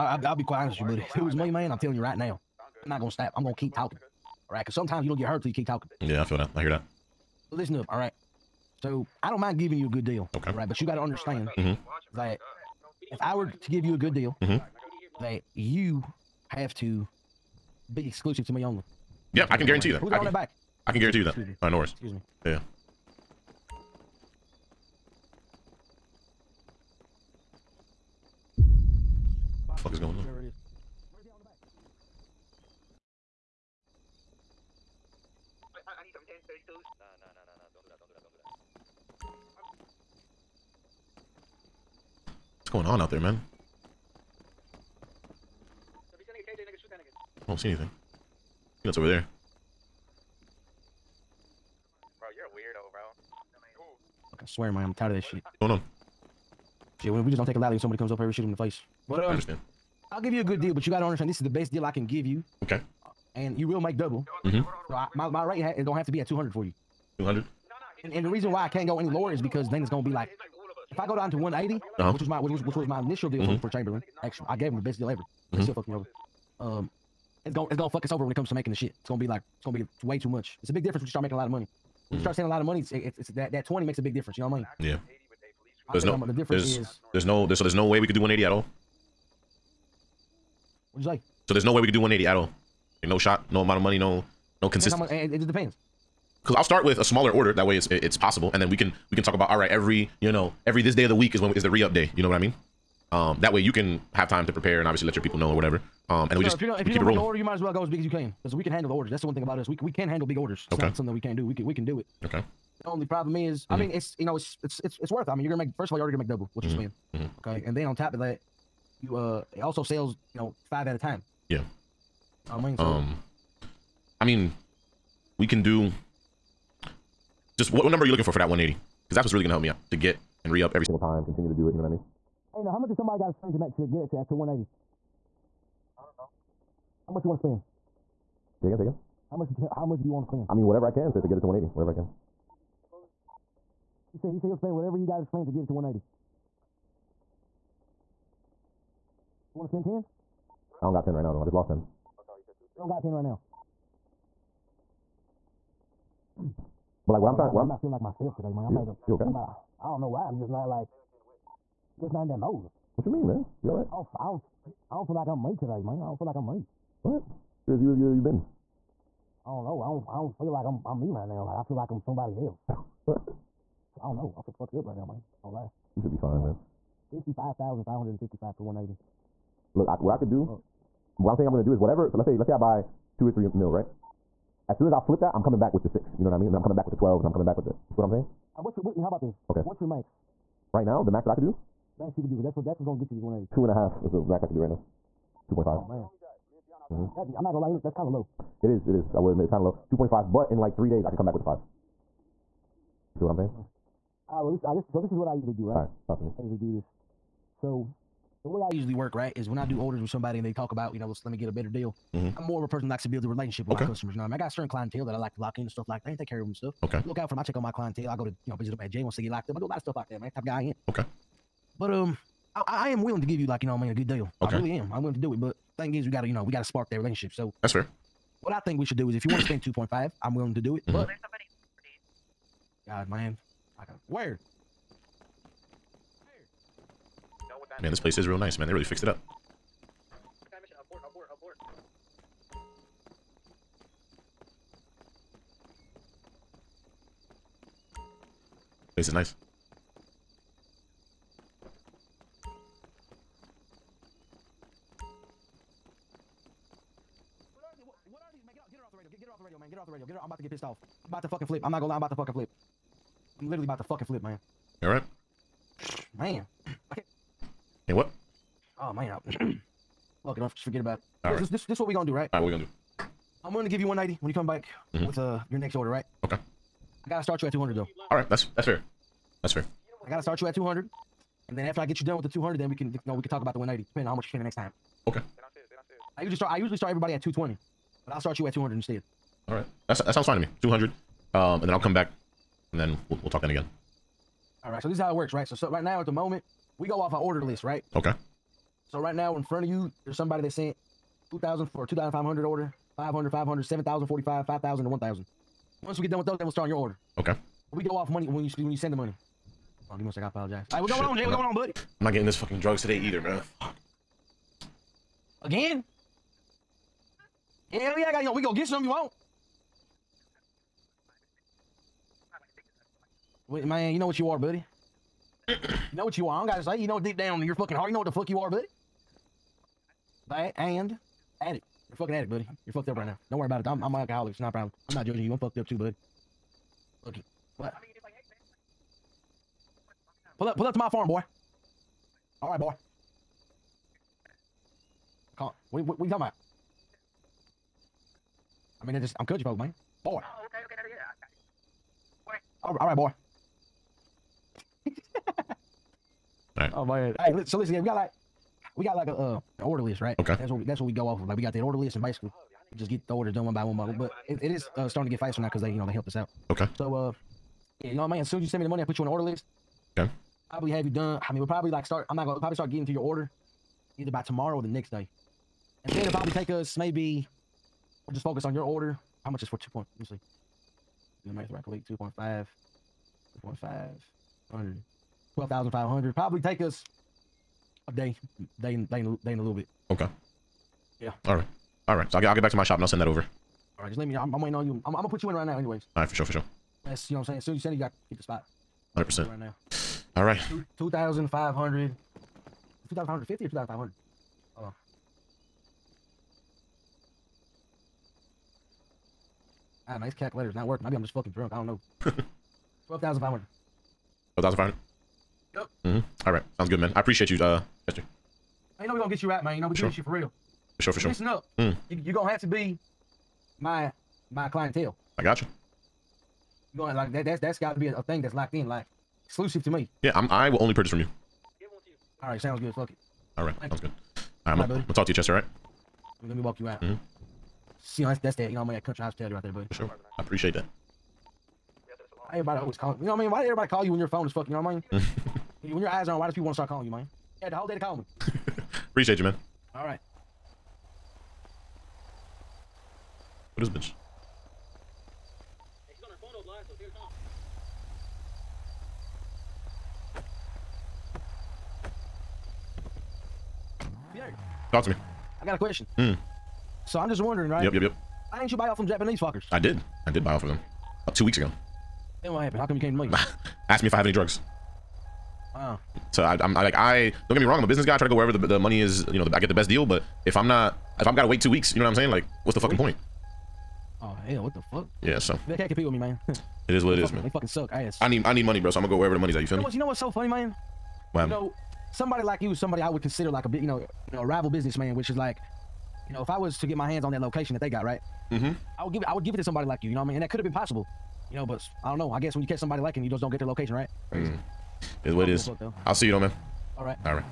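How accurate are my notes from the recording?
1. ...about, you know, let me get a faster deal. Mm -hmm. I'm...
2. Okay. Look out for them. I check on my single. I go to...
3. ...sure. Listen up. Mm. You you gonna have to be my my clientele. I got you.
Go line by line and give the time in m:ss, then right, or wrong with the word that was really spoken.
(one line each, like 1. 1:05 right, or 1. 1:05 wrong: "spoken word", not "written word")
1. 3:30 wrong: "better", not "faster"
2. 3:36 wrong: "clientele", not "single"
3. 7:00 right.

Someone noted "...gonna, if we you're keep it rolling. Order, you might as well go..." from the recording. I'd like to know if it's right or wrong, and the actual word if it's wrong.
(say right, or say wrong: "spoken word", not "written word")
right.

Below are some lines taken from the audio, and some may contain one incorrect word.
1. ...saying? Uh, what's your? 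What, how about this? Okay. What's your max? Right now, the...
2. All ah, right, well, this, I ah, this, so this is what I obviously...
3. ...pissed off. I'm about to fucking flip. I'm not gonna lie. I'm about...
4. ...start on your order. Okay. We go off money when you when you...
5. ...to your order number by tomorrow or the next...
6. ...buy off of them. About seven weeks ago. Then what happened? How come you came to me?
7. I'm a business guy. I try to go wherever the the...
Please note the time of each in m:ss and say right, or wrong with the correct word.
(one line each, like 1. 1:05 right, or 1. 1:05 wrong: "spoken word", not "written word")
1. 3:08 right
2. 3:24 wrong: "usually", not "obviously"
3. 4:20 right
4. 5:06 right
5. 6:12 wrong: "either", not "number"
6. 7:50 wrong: "two", not "seven"
7. 7:57 right.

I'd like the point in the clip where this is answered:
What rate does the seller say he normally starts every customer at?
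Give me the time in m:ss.
4:47.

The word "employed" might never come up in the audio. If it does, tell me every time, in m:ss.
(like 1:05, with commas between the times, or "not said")
not said.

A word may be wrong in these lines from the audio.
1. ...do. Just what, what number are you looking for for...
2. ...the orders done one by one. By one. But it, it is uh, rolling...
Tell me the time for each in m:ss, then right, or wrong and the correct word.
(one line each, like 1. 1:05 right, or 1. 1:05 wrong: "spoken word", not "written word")
1. 2:05 right
2. 6:03 wrong: "starting", not "rolling".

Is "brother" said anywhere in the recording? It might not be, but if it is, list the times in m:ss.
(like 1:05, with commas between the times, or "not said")
not said.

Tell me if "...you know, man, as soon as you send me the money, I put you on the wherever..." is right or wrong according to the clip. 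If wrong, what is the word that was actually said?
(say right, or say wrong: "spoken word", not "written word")
wrong: "order", not "wherever".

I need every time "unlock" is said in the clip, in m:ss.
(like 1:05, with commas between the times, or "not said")
not said.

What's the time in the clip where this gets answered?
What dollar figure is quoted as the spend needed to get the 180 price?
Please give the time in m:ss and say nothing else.
2:57.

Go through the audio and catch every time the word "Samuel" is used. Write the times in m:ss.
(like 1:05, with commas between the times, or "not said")
not said.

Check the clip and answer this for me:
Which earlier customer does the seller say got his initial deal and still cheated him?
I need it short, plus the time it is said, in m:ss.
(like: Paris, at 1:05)
Chamberlain, at 1:13.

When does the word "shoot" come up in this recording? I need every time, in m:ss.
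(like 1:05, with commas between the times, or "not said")
0:58.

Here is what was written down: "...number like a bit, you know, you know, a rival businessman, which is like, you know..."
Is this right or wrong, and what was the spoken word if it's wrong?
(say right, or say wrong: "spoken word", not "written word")
wrong: "consider", not "number".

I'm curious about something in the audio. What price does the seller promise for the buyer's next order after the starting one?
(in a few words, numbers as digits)
190.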